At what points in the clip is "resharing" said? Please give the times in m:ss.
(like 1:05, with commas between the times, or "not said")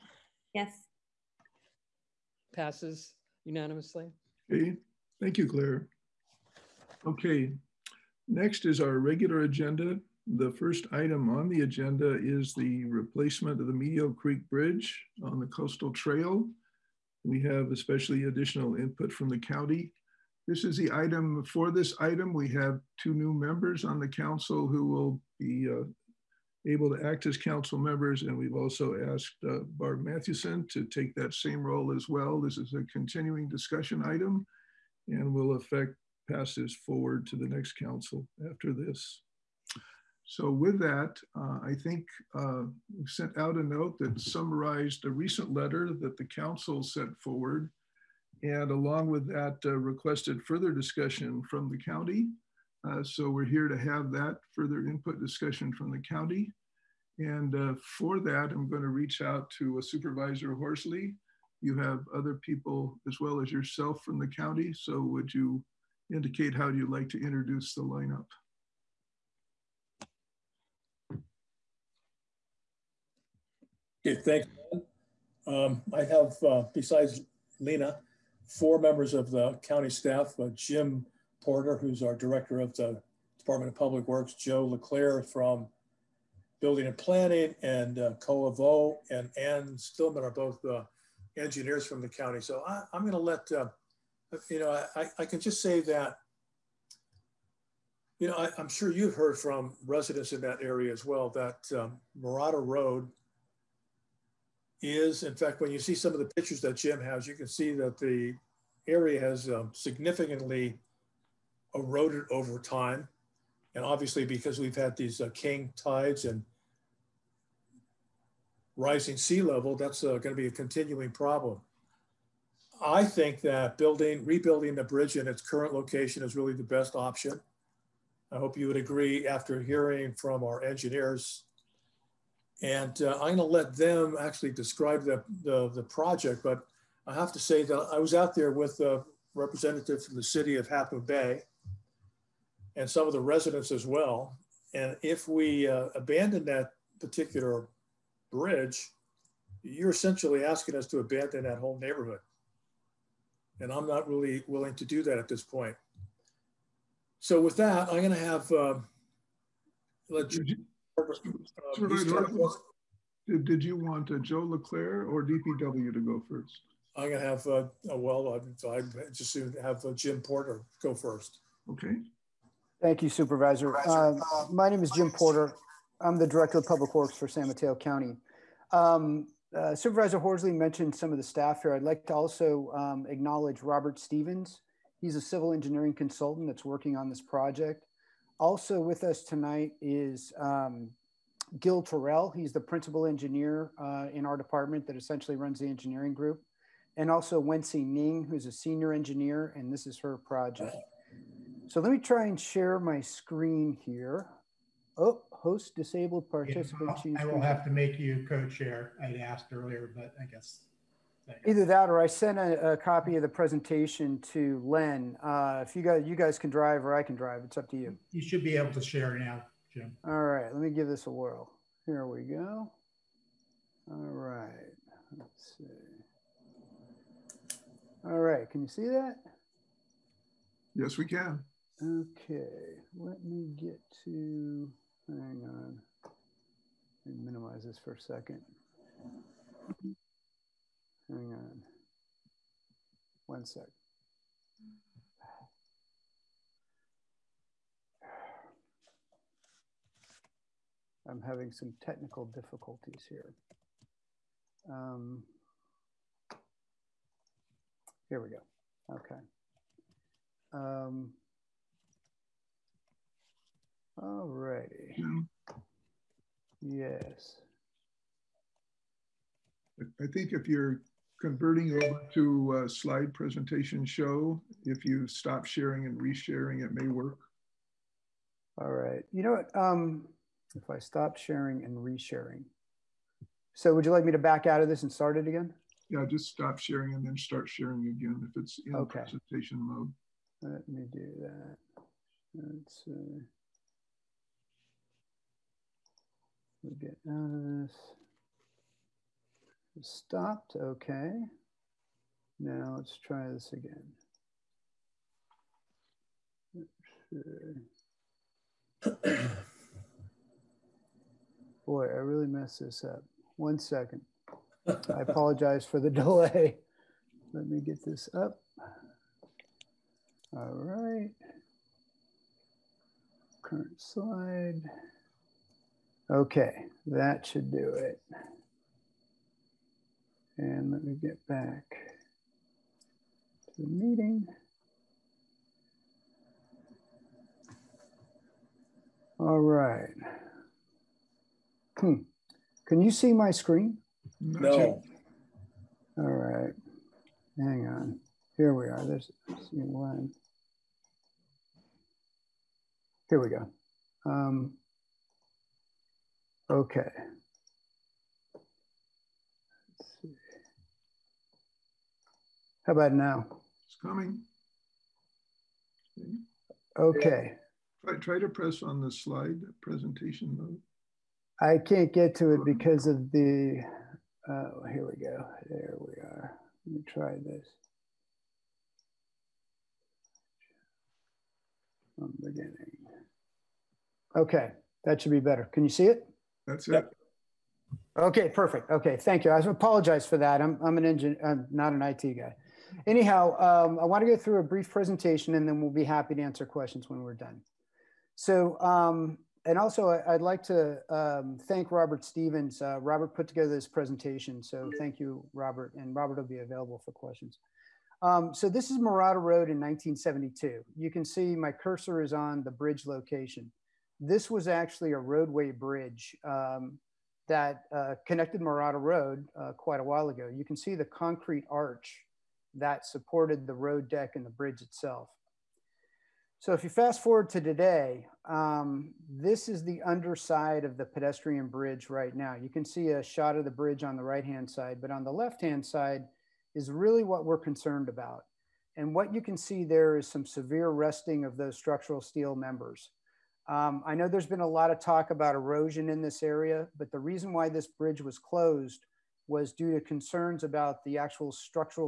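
4:35, 4:41.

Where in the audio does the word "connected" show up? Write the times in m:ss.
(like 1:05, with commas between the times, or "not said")
6:58.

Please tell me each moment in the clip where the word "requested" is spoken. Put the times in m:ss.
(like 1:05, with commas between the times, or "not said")
0:49.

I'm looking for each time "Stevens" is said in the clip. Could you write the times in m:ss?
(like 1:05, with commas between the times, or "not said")
3:03, 6:42.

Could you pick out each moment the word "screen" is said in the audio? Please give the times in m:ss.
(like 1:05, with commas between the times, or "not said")
3:22, 5:43.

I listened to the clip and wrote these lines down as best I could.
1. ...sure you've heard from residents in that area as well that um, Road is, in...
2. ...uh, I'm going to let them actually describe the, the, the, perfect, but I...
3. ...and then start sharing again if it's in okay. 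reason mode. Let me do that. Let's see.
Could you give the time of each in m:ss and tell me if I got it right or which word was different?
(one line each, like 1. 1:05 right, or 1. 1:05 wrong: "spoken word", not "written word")
1. 1:38 right
2. 2:13 wrong: "project", not "perfect"
3. 4:46 wrong: "presentation", not "reason".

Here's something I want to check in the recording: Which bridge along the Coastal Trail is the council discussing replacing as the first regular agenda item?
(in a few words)
Medio Creek Bridge.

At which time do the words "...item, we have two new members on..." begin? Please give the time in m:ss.
0:21.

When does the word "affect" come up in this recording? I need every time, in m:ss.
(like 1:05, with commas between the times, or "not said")
0:35.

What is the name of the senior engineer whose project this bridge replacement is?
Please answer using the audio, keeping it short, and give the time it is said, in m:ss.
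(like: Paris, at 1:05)
Wensi Ning, at 3:17.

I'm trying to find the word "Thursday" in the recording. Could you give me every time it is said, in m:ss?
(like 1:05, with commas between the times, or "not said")
not said.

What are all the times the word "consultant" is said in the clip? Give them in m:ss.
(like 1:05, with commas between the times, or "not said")
3:05.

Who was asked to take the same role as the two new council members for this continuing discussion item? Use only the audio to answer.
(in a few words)
Barb Mathewson.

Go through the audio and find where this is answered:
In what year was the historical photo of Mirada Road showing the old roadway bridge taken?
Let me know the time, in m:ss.
6:49.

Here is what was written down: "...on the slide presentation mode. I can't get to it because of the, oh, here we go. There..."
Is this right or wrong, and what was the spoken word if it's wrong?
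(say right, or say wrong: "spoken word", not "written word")
right.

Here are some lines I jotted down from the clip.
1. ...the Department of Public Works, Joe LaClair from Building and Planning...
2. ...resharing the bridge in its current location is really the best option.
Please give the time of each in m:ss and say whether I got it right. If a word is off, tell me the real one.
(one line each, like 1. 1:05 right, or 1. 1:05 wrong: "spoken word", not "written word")
1. 1:22 right
2. 2:04 wrong: "rebuilding", not "resharing".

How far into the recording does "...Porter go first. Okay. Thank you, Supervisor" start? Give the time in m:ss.
2:50.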